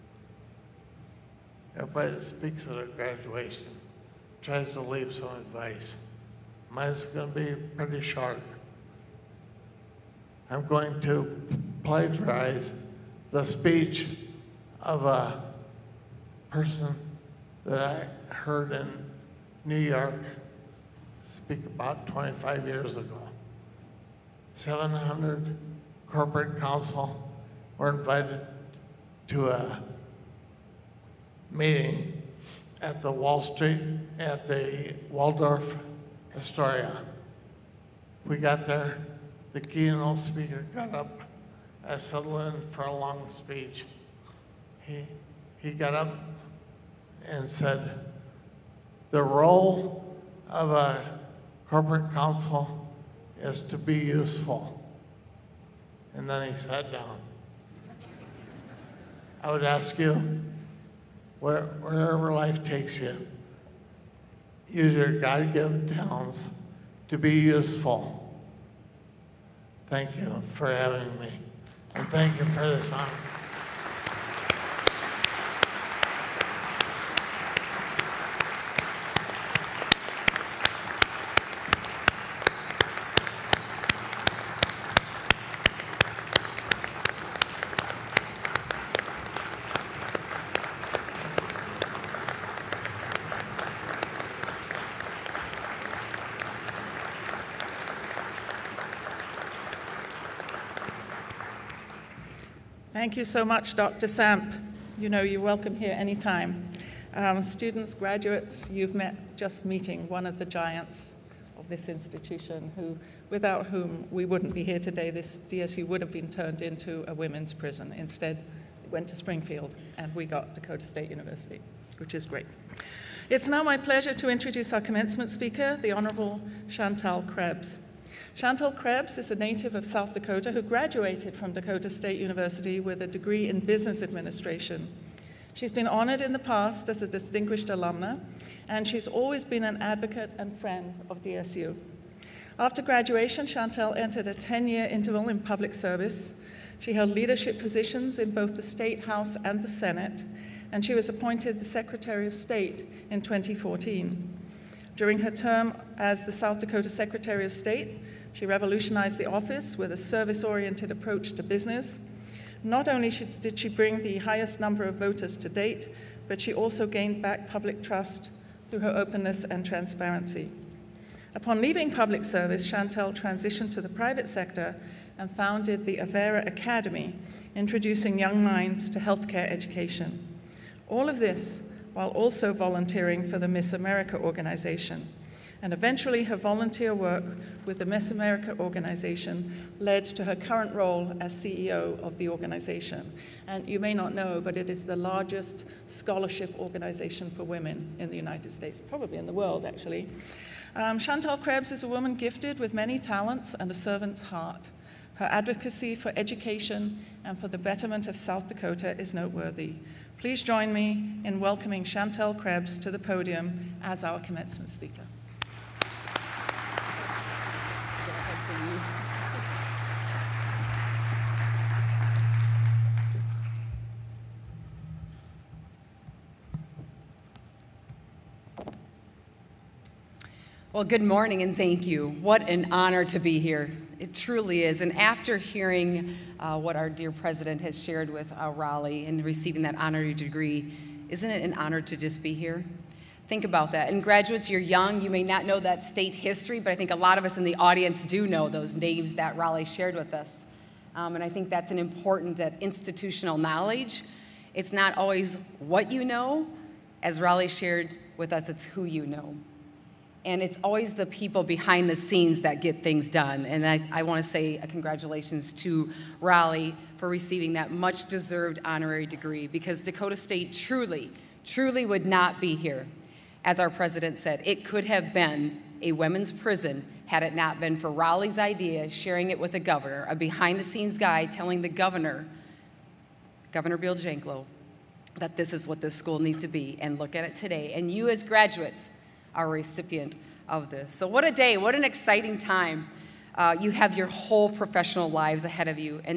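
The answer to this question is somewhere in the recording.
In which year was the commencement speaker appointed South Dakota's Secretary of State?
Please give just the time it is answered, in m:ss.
2:33.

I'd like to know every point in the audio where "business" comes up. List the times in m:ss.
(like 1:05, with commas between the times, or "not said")
2:13, 2:41.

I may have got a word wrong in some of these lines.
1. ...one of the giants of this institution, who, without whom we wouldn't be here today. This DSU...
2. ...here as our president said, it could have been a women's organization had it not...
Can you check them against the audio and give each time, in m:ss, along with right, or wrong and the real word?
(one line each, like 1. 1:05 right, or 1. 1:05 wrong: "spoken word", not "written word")
1. 1:50 right
2. 4:32 wrong: "prison", not "organization".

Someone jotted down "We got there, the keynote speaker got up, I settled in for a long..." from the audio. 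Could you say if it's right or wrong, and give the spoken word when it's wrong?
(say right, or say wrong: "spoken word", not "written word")
right.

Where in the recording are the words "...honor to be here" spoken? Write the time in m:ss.
3:52.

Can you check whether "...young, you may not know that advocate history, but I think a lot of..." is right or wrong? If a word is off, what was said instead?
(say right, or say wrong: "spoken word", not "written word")
wrong: "state", not "advocate".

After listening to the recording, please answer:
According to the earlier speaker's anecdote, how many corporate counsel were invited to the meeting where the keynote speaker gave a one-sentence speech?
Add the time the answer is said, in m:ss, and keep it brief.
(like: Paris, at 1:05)
700, at 0:24.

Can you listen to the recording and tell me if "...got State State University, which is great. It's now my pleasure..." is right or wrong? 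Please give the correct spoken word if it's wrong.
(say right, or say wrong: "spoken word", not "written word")
wrong: "Dakota", not "State".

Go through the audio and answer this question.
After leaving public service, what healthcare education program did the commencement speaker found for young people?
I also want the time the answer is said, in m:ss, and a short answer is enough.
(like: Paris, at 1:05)
Avera Academy, at 2:55.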